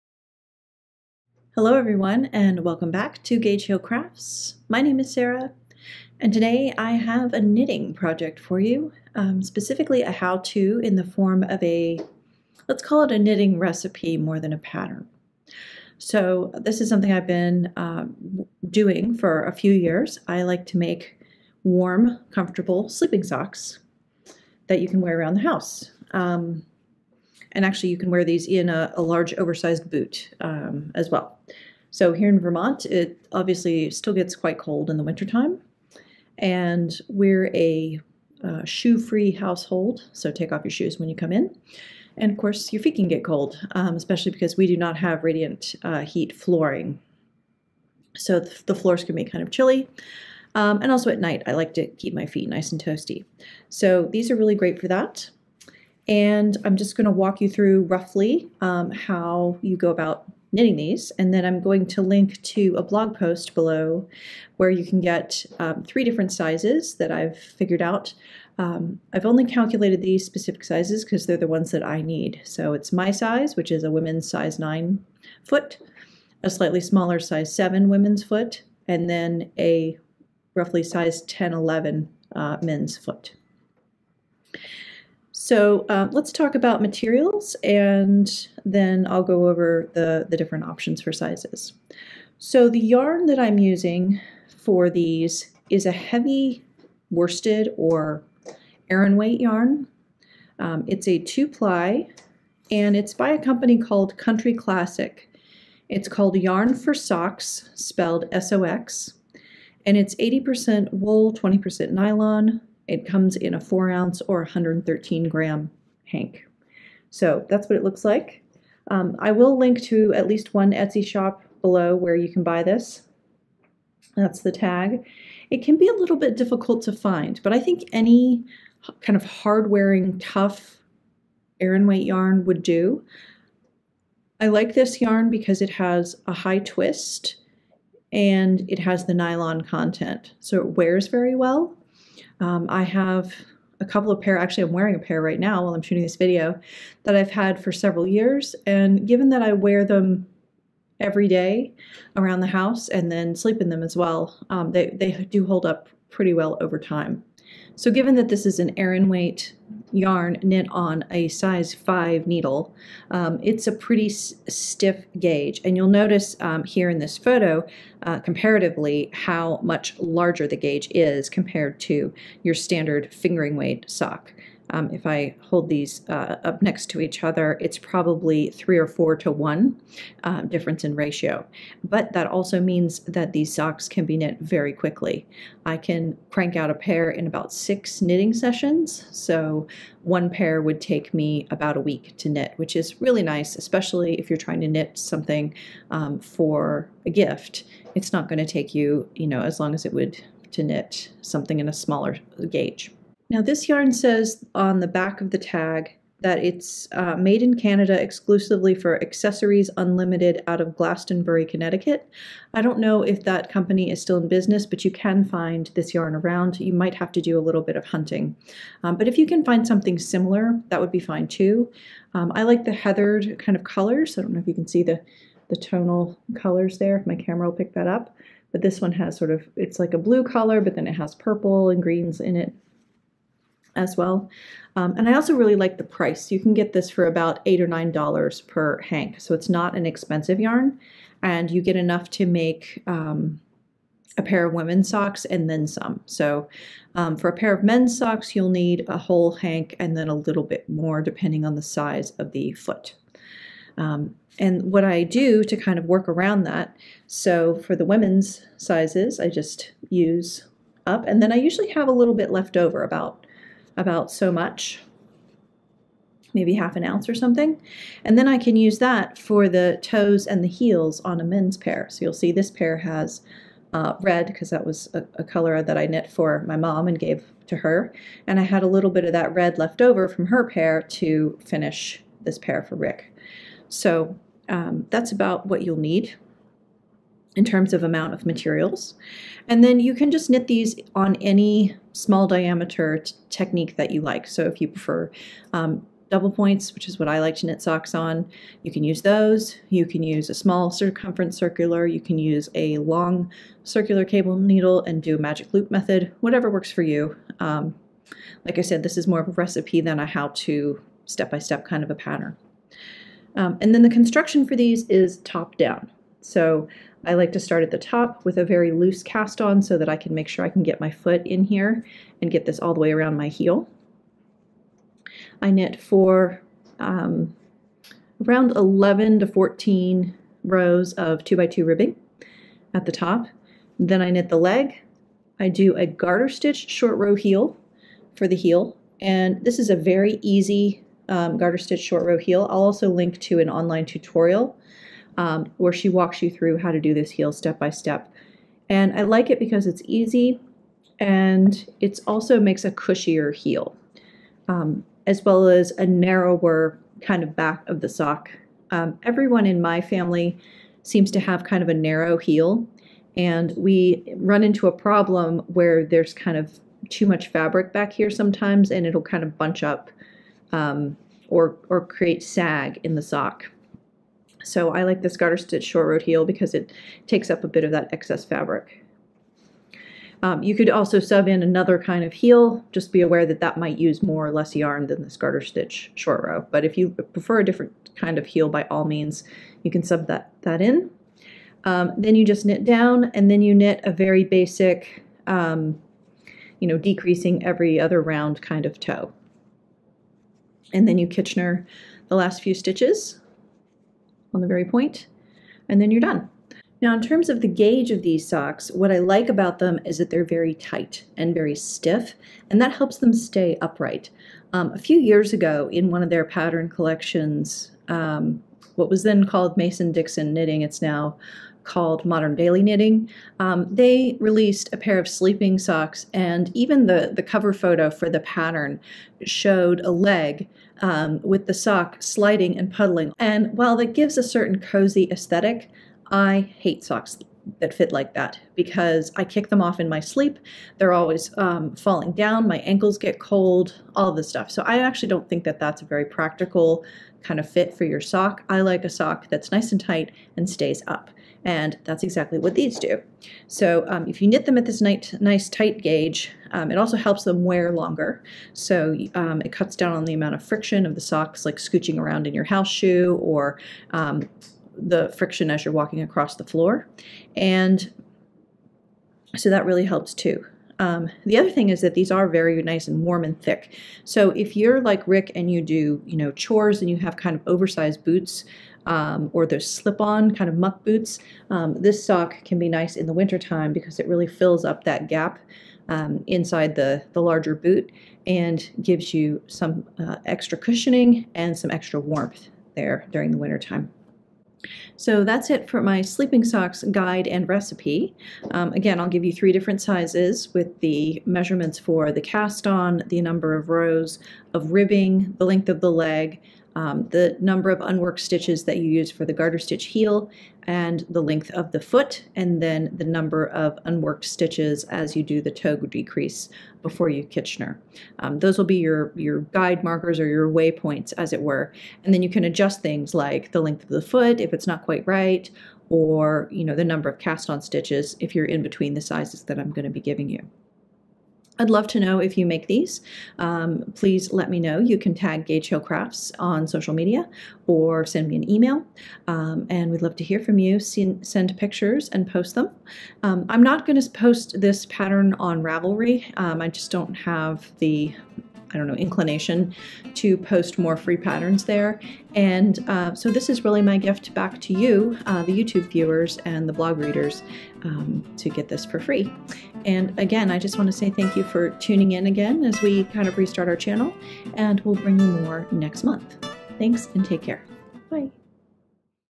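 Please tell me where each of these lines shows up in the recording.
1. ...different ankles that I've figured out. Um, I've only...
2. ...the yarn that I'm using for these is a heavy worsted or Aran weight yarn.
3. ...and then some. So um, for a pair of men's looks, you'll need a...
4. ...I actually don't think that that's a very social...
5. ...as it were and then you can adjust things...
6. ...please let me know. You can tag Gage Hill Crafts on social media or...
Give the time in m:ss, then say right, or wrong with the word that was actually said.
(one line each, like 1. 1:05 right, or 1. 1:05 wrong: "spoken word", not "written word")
1. 1:06 wrong: "sizes", not "ankles"
2. 1:32 right
3. 4:05 wrong: "socks", not "looks"
4. 7:24 wrong: "practical", not "social"
5. 8:41 right
6. 8:53 right.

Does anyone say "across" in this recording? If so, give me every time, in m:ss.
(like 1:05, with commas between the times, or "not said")
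7:46.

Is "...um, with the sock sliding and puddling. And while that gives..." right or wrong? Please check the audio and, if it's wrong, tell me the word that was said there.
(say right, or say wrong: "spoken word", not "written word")
right.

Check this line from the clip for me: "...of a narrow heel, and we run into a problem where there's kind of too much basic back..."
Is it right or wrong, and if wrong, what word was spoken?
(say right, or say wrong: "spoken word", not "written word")
wrong: "fabric", not "basic".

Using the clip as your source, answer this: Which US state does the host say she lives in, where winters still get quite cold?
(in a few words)
Vermont.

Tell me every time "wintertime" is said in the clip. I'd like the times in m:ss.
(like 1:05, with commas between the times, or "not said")
0:35, 8:03, 8:13.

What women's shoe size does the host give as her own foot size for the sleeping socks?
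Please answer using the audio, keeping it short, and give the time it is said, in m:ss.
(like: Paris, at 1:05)
9, at 1:14.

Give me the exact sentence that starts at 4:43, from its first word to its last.
So um, that's about what you'll need in terms of amount of materials.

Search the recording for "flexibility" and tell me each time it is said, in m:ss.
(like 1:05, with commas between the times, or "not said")
not said.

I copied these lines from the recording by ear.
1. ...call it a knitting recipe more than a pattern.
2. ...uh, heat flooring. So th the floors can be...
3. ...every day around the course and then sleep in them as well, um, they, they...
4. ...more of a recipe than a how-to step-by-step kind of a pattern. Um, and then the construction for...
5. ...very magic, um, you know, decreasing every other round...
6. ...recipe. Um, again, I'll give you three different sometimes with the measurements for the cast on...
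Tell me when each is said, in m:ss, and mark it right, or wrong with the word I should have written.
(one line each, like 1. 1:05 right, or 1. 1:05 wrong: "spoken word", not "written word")
1. 0:12 right
2. 0:45 right
3. 2:30 wrong: "house", not "course"
4. 5:09 right
5. 6:33 wrong: "basic", not "magic"
6. 8:17 wrong: "sizes", not "sometimes".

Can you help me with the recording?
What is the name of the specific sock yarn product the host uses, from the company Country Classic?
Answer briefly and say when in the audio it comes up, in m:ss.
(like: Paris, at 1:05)
Yarn for Sox, at 1:46.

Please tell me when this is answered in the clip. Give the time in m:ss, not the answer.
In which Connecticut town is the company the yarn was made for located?
3:30.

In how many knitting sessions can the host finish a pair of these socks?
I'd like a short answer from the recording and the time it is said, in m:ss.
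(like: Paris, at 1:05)
6, at 3:07.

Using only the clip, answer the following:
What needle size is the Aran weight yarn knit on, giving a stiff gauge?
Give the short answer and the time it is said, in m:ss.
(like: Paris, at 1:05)
5, at 2:41.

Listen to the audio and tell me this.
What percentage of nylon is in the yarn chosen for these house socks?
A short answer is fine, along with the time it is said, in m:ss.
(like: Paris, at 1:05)
20%, at 1:51.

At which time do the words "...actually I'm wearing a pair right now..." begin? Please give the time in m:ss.
2:24.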